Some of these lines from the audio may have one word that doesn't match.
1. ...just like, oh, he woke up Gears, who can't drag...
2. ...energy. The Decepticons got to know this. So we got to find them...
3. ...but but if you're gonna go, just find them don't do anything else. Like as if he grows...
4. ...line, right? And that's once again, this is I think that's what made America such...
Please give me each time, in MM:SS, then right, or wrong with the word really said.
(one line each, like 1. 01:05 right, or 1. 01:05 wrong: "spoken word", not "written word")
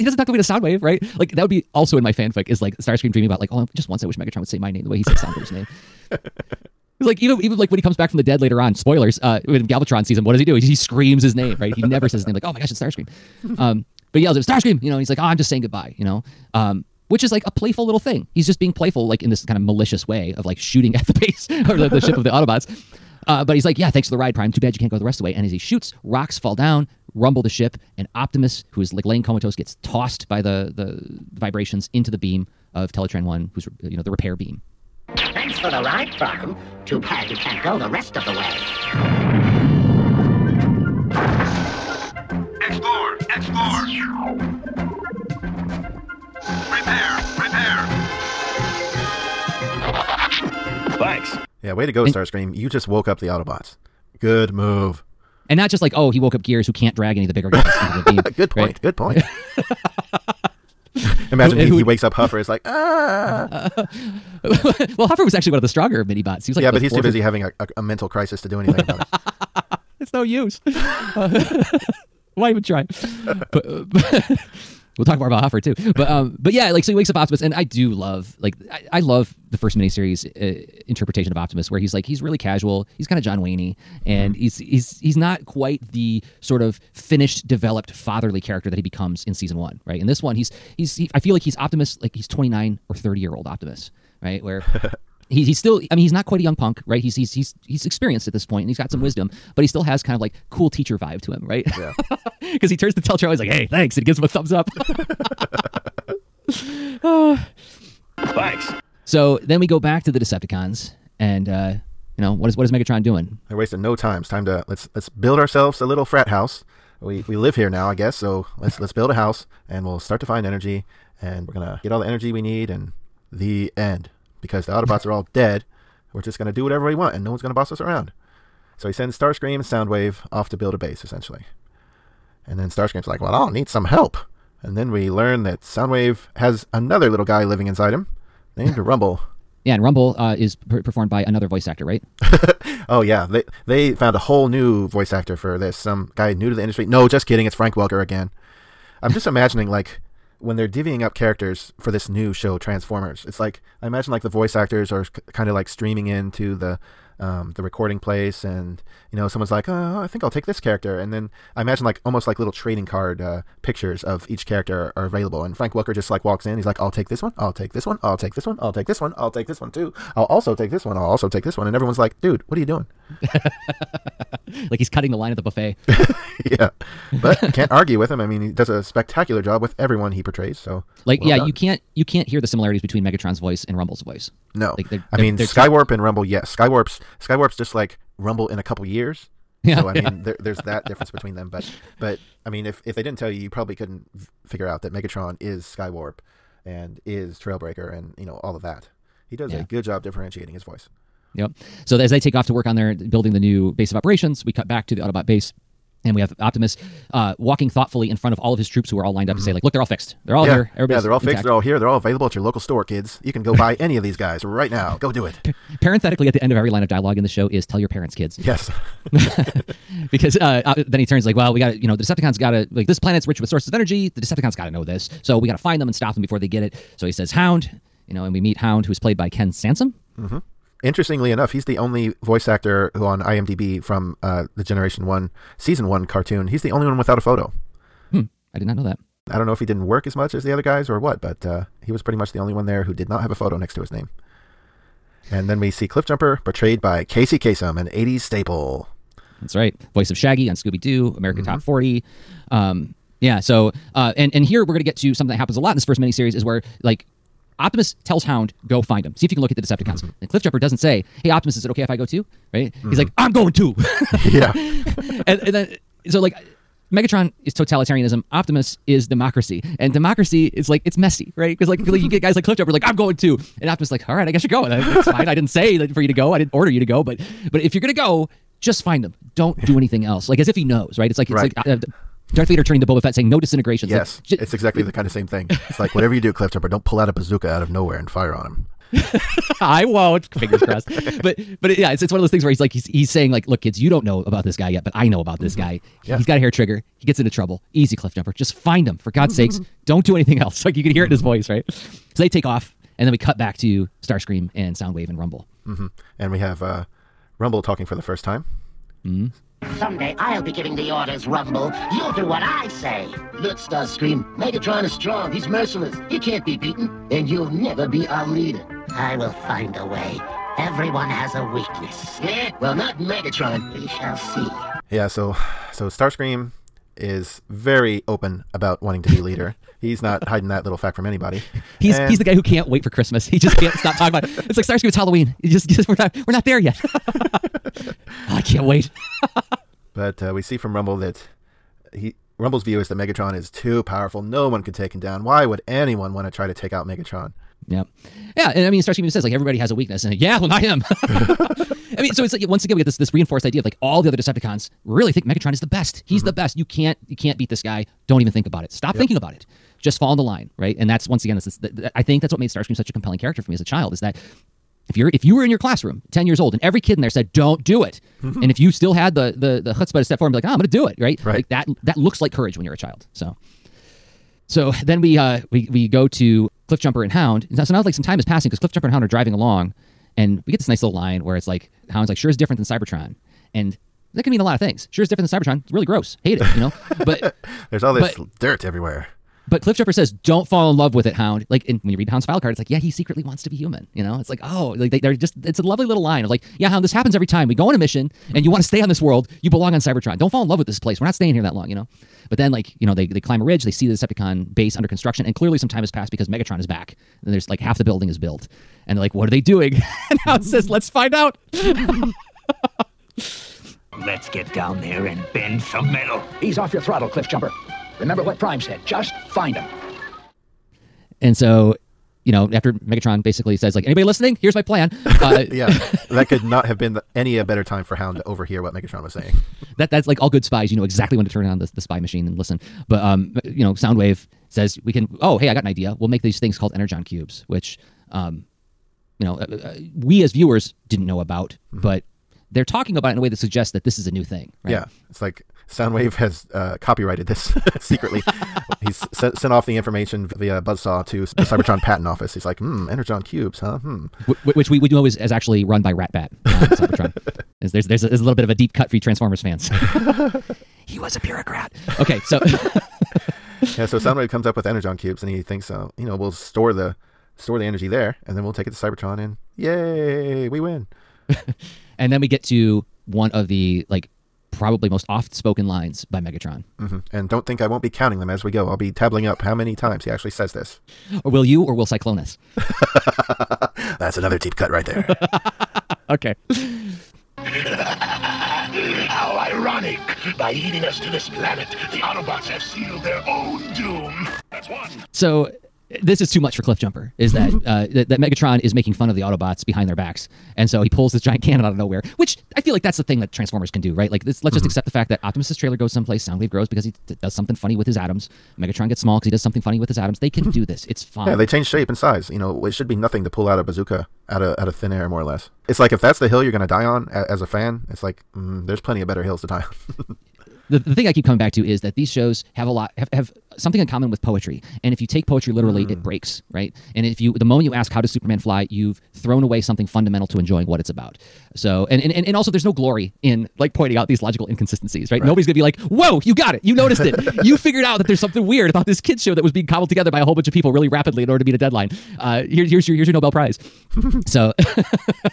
1. 00:55 right
2. 03:43 right
3. 04:37 wrong: "knows", not "grows"
4. 06:00 wrong: "Starscream", not "America".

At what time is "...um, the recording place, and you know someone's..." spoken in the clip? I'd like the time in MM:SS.
02:37.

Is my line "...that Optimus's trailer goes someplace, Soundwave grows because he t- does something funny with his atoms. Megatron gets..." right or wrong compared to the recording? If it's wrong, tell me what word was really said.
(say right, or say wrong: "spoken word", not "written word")
right.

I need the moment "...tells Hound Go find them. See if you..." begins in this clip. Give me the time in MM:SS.
04:18.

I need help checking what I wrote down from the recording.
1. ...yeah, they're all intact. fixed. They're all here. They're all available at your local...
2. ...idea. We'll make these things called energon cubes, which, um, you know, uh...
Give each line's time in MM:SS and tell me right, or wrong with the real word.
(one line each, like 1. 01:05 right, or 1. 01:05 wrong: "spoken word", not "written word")
1. 03:31 right
2. 07:15 right.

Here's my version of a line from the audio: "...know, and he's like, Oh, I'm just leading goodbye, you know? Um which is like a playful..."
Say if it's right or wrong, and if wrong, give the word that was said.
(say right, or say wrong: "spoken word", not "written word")
wrong: "saying", not "leading".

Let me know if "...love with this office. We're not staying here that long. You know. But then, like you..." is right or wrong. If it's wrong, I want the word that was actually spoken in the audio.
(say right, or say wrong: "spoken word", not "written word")
wrong: "place", not "office".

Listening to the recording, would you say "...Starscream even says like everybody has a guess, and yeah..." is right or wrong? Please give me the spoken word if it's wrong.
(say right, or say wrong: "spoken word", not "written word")
wrong: "weakness", not "guess".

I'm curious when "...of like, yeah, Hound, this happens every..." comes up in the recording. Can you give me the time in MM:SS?
06:36.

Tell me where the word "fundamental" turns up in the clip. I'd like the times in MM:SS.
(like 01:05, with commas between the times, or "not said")
08:49.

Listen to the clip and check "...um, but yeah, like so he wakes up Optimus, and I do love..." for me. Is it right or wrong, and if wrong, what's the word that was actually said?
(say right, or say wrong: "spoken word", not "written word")
right.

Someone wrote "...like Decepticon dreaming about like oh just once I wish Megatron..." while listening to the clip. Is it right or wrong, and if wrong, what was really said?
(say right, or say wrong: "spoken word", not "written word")
wrong: "Starscream", not "Decepticon".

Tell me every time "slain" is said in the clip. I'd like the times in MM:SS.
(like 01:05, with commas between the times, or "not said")
not said.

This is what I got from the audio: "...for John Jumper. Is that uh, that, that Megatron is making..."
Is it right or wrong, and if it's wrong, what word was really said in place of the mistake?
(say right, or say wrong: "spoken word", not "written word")
wrong: "Cliff", not "John".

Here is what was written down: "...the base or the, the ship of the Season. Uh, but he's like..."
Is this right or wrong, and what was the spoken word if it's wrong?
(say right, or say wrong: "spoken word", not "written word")
wrong: "Autobots", not "Season".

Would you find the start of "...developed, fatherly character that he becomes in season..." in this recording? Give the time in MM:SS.
01:27.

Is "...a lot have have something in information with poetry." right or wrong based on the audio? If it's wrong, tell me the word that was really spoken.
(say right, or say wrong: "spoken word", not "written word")
wrong: "common", not "information".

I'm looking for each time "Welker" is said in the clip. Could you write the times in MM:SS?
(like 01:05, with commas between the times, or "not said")
02:27, 02:45.